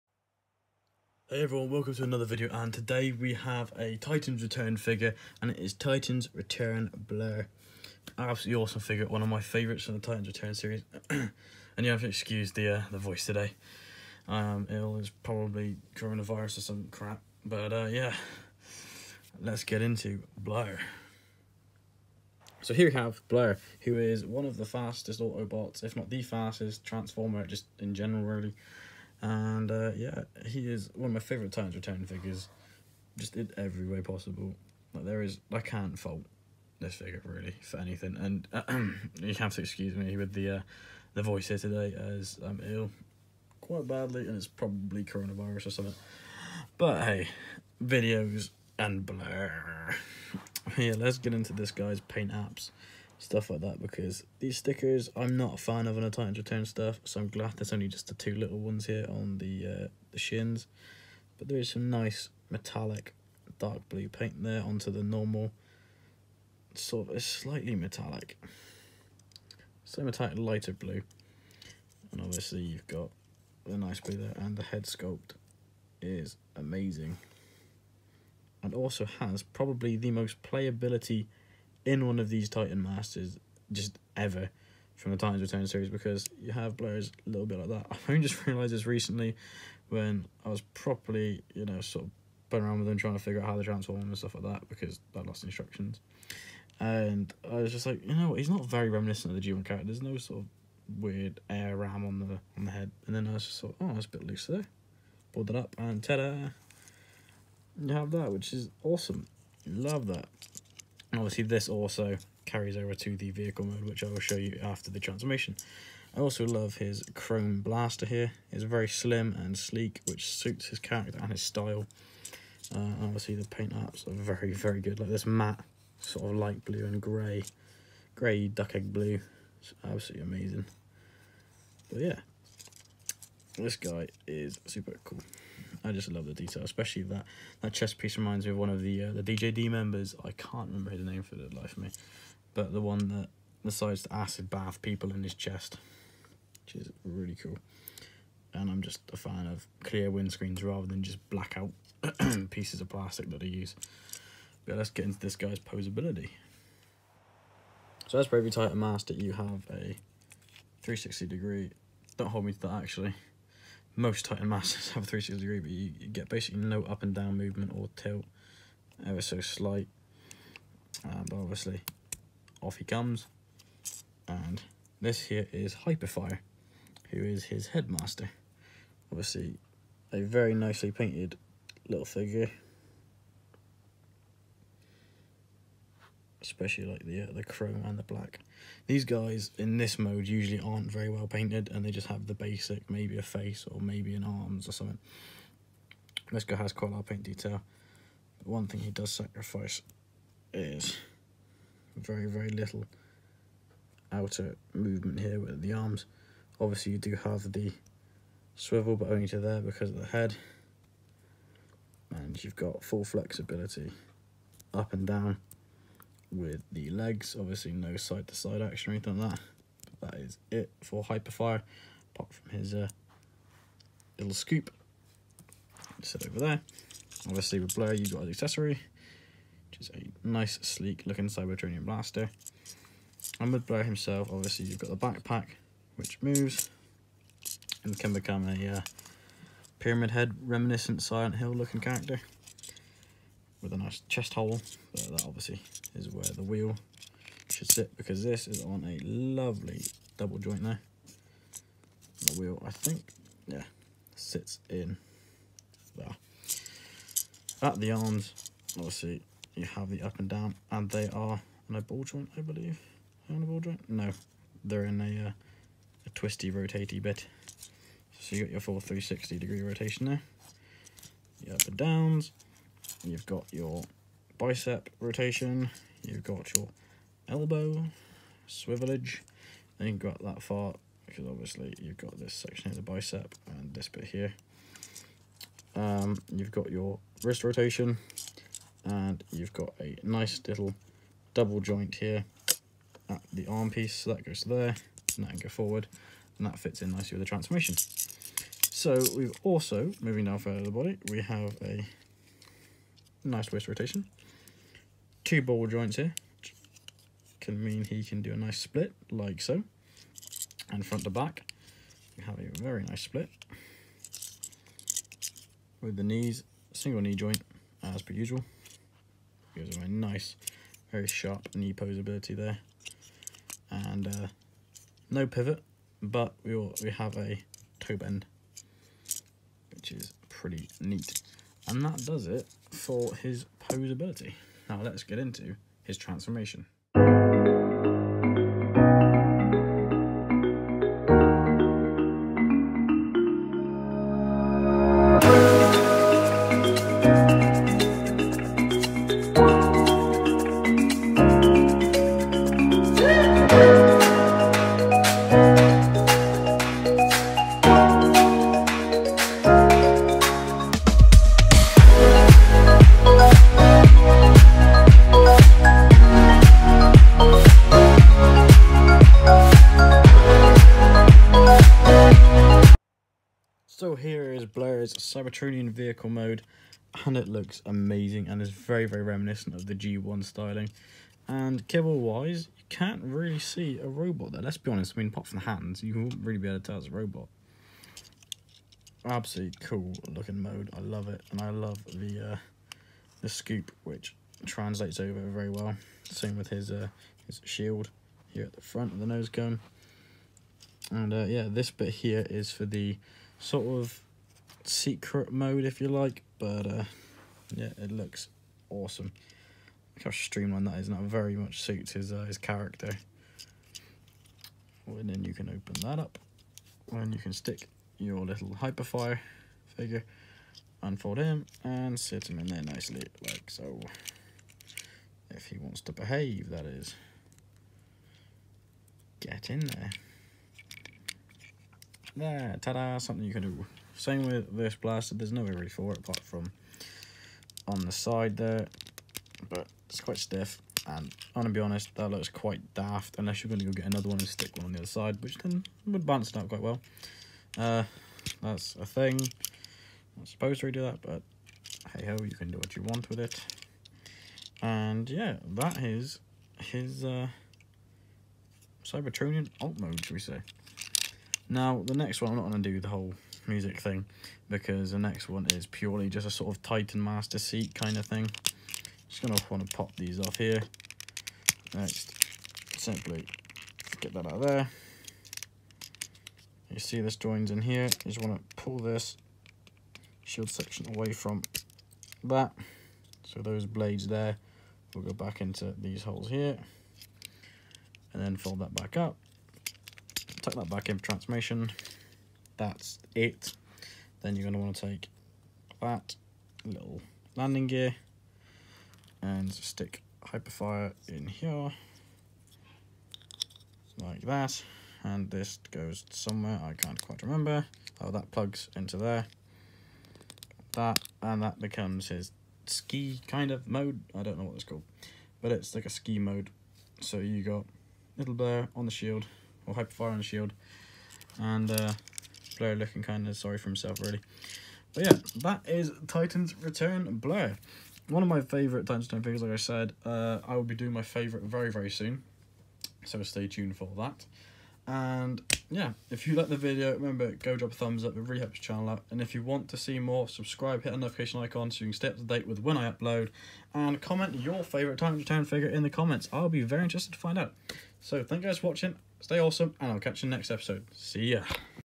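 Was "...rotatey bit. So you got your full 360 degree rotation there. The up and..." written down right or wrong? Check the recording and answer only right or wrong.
right.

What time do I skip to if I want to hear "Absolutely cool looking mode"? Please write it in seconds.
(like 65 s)
389 s.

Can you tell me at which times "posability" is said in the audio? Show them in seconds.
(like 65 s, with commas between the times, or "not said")
155 s, 333 s.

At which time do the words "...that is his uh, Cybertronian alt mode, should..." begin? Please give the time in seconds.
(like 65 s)
455 s.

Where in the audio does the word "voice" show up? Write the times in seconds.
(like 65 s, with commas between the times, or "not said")
12 s, 41 s.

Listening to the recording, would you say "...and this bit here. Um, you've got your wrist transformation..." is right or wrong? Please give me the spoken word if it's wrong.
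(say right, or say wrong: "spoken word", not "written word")
wrong: "rotation", not "transformation".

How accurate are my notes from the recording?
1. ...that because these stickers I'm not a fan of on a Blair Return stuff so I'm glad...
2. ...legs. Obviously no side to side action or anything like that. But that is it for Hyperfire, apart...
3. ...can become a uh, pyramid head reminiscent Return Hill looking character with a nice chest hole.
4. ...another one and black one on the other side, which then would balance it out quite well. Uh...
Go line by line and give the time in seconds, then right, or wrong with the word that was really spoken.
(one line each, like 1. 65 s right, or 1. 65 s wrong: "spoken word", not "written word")
1. 53 s wrong: "Titans", not "Blair"
2. 216 s right
3. 237 s wrong: "Silent", not "Return"
4. 443 s wrong: "stick", not "black".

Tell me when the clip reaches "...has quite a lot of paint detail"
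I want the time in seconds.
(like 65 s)
196 s.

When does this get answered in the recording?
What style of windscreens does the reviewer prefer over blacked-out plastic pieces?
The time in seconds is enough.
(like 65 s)
149 s.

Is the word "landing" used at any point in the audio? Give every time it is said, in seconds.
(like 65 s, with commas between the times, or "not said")
497 s.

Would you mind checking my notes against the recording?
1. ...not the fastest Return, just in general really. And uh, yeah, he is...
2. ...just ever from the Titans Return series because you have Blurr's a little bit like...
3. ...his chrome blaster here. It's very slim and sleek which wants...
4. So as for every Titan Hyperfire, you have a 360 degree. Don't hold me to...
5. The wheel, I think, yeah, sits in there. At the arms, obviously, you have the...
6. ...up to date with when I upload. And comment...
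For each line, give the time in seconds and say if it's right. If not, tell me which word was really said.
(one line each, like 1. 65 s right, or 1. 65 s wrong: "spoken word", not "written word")
1. 25 s wrong: "Transformer", not "Return"
2. 83 s right
3. 116 s wrong: "suits", not "wants"
4. 158 s wrong: "Master", not "Hyperfire"
5. 252 s right
6. 542 s right.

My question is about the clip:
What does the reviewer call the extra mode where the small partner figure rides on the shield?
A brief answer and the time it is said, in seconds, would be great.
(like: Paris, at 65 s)
Ski mode, at 515 s.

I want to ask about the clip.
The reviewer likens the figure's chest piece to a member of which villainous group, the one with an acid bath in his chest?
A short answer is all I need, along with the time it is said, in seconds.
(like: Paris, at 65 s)
DJD, at 139 s.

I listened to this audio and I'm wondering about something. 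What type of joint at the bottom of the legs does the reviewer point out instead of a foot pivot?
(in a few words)
Toe bend.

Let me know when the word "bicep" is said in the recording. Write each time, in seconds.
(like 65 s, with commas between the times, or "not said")
274 s, 282 s.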